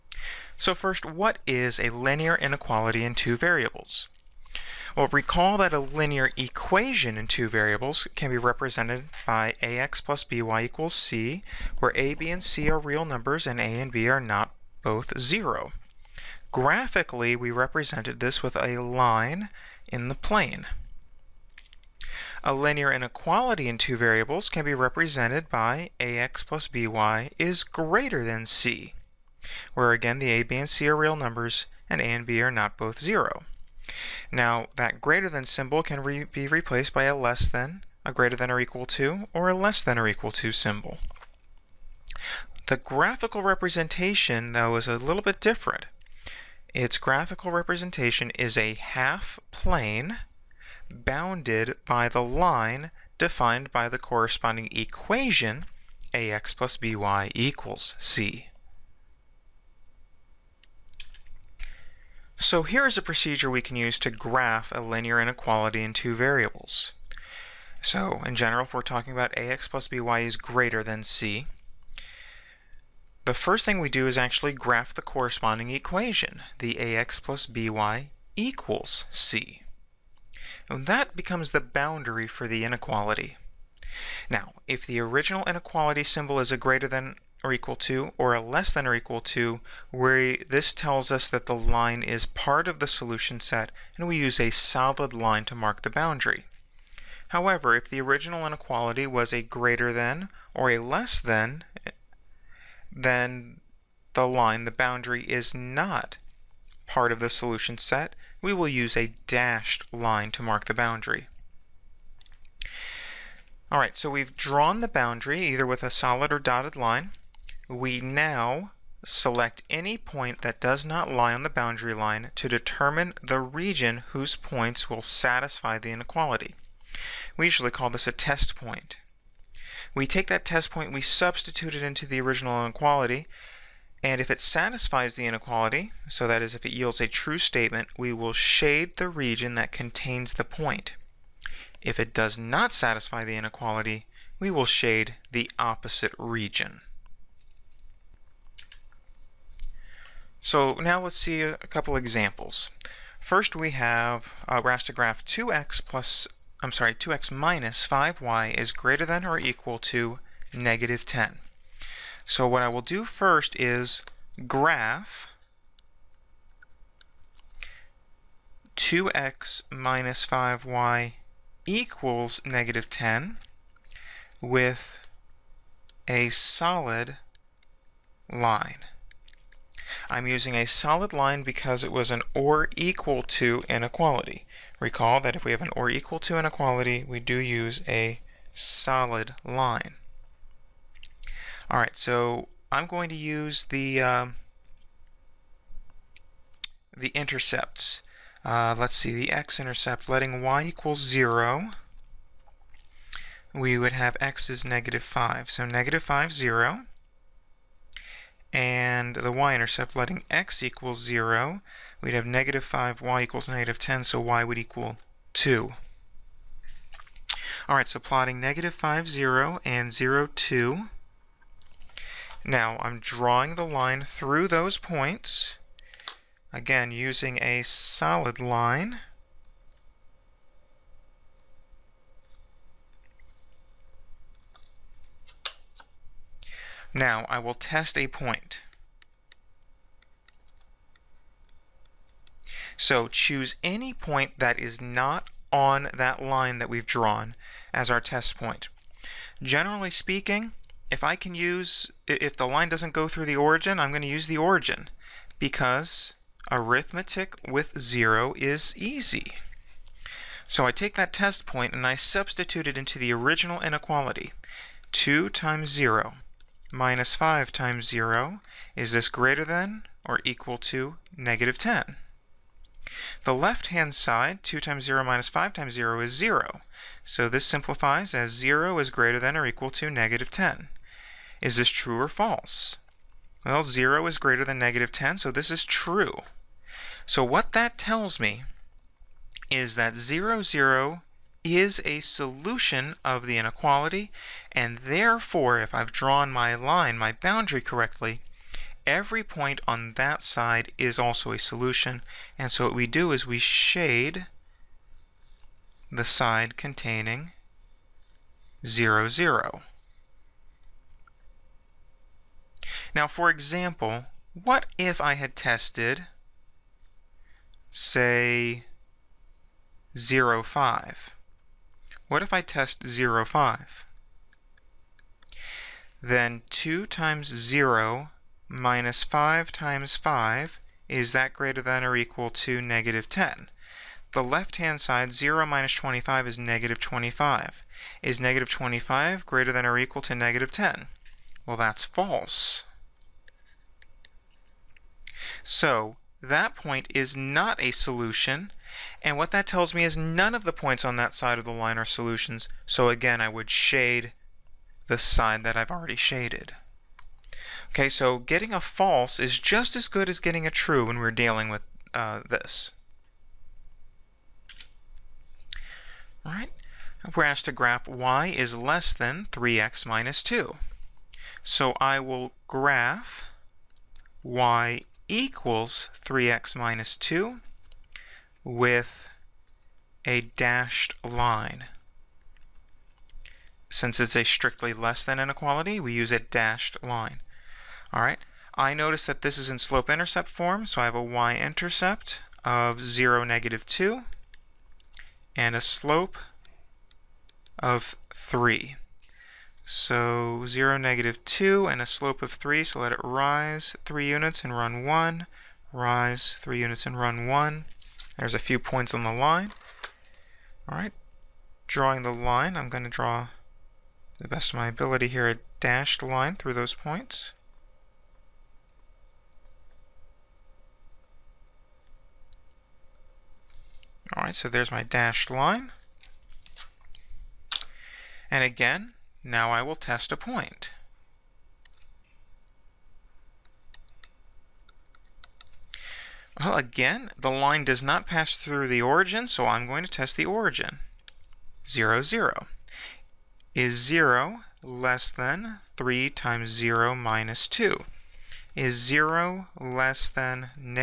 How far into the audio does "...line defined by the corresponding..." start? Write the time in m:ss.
0:52.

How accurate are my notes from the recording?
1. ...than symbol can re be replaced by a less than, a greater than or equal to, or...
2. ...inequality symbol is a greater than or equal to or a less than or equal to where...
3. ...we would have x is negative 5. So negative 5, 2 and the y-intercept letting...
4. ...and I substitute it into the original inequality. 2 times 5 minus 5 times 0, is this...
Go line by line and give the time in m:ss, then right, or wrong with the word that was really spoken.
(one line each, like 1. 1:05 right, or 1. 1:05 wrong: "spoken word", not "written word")
1. 0:35 right
2. 1:25 right
3. 3:23 wrong: "0", not "2"
4. 4:21 wrong: "0", not "5".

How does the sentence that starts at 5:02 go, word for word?
And so what we do is we shade the side containing 0, 0.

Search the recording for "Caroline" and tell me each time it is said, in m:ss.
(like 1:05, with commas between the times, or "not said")
not said.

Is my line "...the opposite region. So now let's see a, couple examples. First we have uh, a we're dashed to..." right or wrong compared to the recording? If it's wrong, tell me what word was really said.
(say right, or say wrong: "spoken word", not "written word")
wrong: "asked", not "dashed".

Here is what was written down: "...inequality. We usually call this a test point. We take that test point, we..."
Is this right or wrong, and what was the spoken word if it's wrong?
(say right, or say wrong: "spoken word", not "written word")
right.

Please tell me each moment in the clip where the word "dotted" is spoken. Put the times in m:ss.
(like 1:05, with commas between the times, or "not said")
1:56.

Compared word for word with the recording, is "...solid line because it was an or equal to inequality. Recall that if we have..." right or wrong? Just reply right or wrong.
right.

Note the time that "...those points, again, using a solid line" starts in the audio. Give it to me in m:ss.
3:44.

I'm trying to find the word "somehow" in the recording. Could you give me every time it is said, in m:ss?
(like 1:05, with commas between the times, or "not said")
not said.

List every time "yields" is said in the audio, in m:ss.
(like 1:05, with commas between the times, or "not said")
2:16.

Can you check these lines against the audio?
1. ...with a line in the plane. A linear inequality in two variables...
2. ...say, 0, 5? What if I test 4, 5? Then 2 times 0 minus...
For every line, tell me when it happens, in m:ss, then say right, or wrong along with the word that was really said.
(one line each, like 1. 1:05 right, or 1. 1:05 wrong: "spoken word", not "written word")
1. 0:18 right
2. 5:17 wrong: "0", not "4".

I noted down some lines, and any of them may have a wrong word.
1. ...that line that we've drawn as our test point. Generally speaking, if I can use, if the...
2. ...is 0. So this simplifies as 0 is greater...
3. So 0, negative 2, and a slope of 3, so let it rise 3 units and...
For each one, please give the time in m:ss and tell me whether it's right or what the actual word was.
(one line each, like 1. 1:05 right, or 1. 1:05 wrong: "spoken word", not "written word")
1. 4:05 right
2. 4:36 right
3. 6:39 right.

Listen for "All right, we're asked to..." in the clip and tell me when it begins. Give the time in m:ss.
6:06.